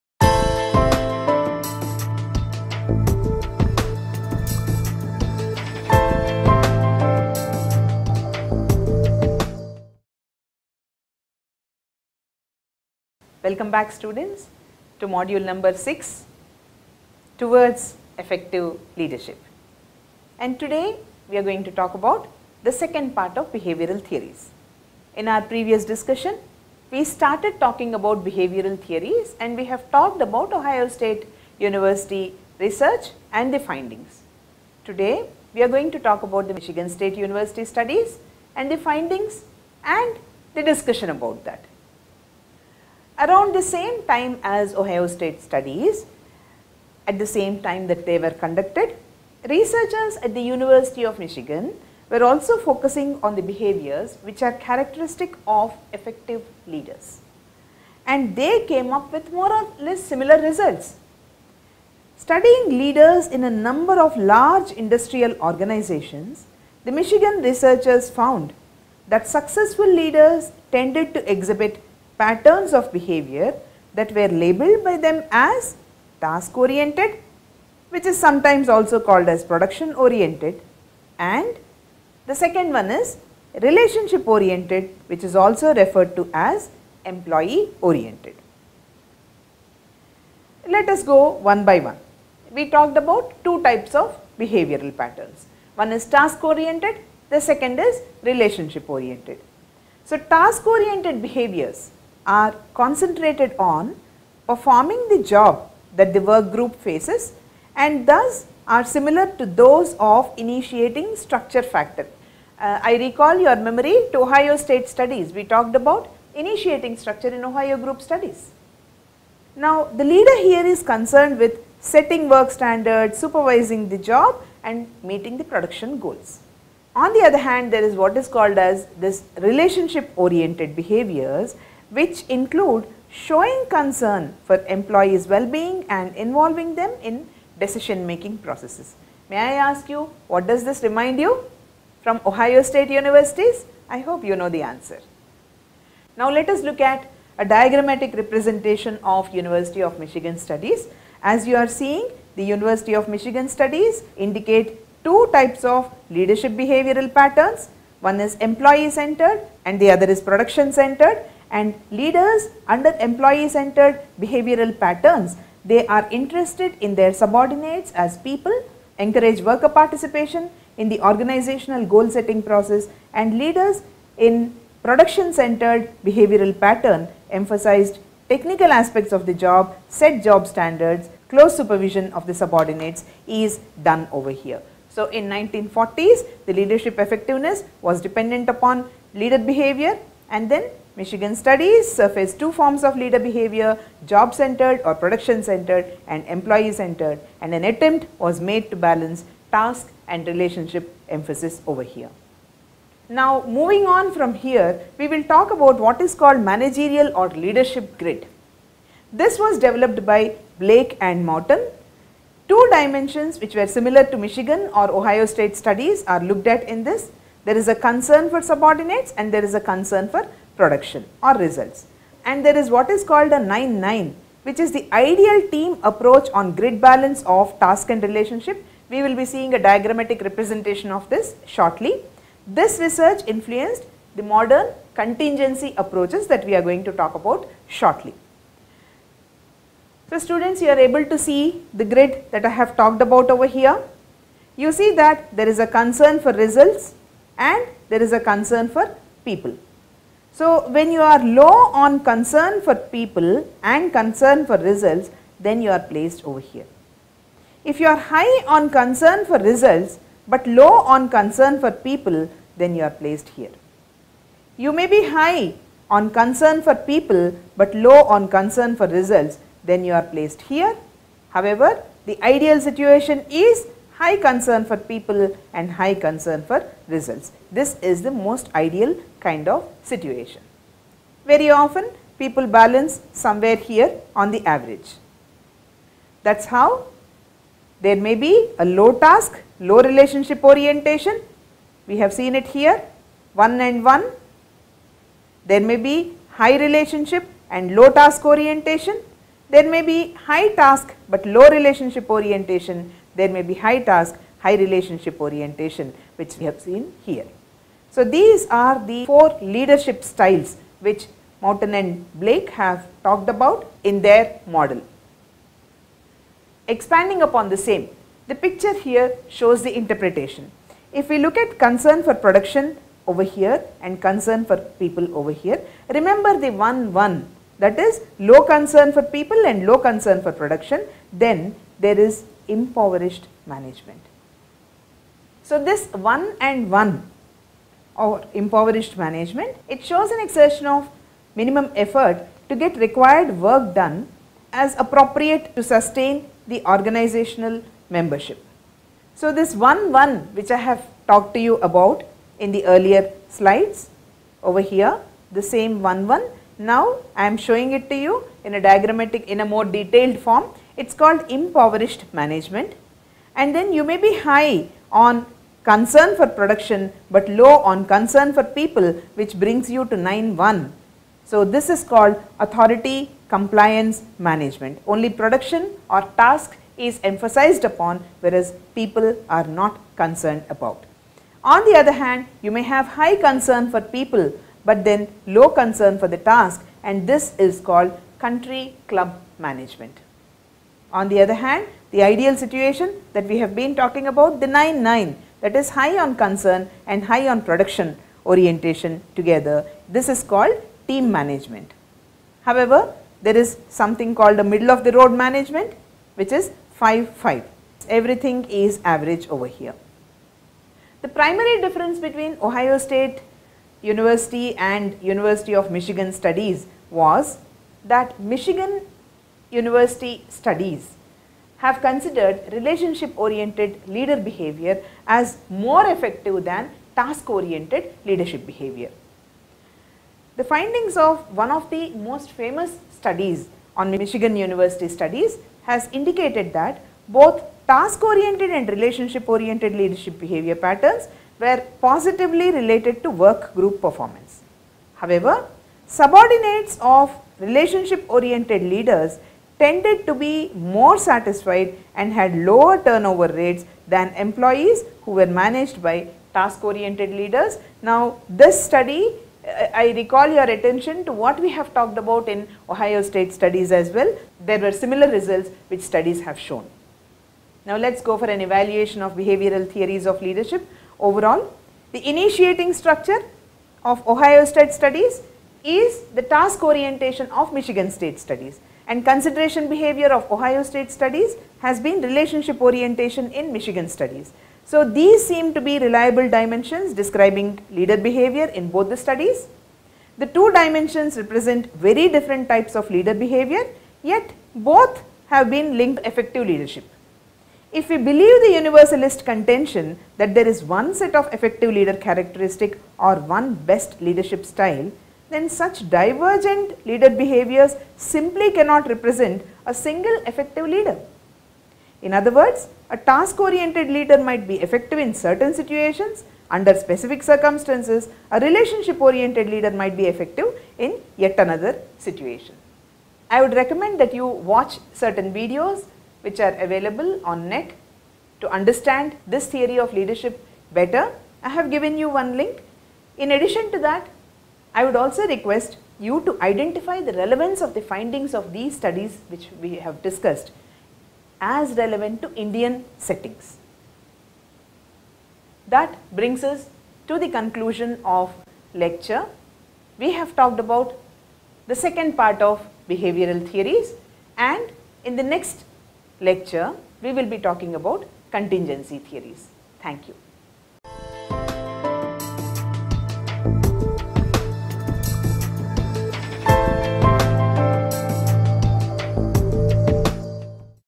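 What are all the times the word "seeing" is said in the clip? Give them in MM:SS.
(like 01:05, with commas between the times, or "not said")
02:31, 03:49.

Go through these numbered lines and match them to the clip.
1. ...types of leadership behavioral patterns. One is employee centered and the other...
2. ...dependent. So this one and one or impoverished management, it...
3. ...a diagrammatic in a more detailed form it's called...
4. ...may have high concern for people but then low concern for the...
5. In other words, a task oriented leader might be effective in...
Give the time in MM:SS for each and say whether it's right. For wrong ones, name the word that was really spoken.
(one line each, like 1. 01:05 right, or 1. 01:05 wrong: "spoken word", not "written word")
1. 02:35 right
2. 05:33 wrong: "management", not "dependent"
3. 05:58 right
4. 06:22 right
5. 08:32 right.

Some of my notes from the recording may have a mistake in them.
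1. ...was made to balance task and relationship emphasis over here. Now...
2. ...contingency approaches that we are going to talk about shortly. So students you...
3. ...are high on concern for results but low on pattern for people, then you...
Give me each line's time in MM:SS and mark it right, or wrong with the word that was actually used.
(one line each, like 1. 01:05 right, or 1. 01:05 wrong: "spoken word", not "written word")
1. 03:18 right
2. 03:54 right
3. 04:17 wrong: "concern", not "pattern".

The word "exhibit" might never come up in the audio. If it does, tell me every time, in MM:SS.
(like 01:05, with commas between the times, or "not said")
01:11.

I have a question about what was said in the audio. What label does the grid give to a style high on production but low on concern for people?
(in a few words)
authority compliance management.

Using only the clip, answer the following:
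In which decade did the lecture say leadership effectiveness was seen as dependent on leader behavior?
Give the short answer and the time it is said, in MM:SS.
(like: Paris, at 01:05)
1940s, at 03:05.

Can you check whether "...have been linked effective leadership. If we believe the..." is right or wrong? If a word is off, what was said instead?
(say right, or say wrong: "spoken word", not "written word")
right.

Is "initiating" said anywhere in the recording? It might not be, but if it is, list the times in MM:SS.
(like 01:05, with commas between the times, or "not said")
01:50, 01:56, 07:52.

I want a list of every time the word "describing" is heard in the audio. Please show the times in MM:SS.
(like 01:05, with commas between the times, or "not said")
08:07.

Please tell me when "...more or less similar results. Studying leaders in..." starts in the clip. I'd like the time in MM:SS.
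00:59.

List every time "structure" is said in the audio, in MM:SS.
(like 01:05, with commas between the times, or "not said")
01:51, 01:56, 07:52.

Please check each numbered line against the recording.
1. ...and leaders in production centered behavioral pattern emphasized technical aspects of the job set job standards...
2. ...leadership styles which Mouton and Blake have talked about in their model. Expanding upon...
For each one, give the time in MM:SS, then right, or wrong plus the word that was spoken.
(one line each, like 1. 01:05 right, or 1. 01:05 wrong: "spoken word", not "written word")
1. 02:53 right
2. 05:09 right.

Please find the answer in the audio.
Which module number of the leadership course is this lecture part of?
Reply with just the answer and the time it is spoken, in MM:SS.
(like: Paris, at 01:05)
6, at 00:15.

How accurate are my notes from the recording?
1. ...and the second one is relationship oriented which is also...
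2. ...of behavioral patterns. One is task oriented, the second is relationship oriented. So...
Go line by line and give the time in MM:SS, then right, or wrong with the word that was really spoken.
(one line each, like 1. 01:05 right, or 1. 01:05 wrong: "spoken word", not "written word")
1. 01:21 right
2. 01:34 right.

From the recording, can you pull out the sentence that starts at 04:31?
However, the ideal situation is high concern for people and high concern for results.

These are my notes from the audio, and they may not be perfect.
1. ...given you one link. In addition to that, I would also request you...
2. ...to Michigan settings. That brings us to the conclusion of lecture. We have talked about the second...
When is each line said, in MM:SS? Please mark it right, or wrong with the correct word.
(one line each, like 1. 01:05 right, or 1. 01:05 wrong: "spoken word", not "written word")
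1. 08:51 right
2. 09:02 wrong: "Indian", not "Michigan".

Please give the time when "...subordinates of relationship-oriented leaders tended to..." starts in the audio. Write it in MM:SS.
07:25.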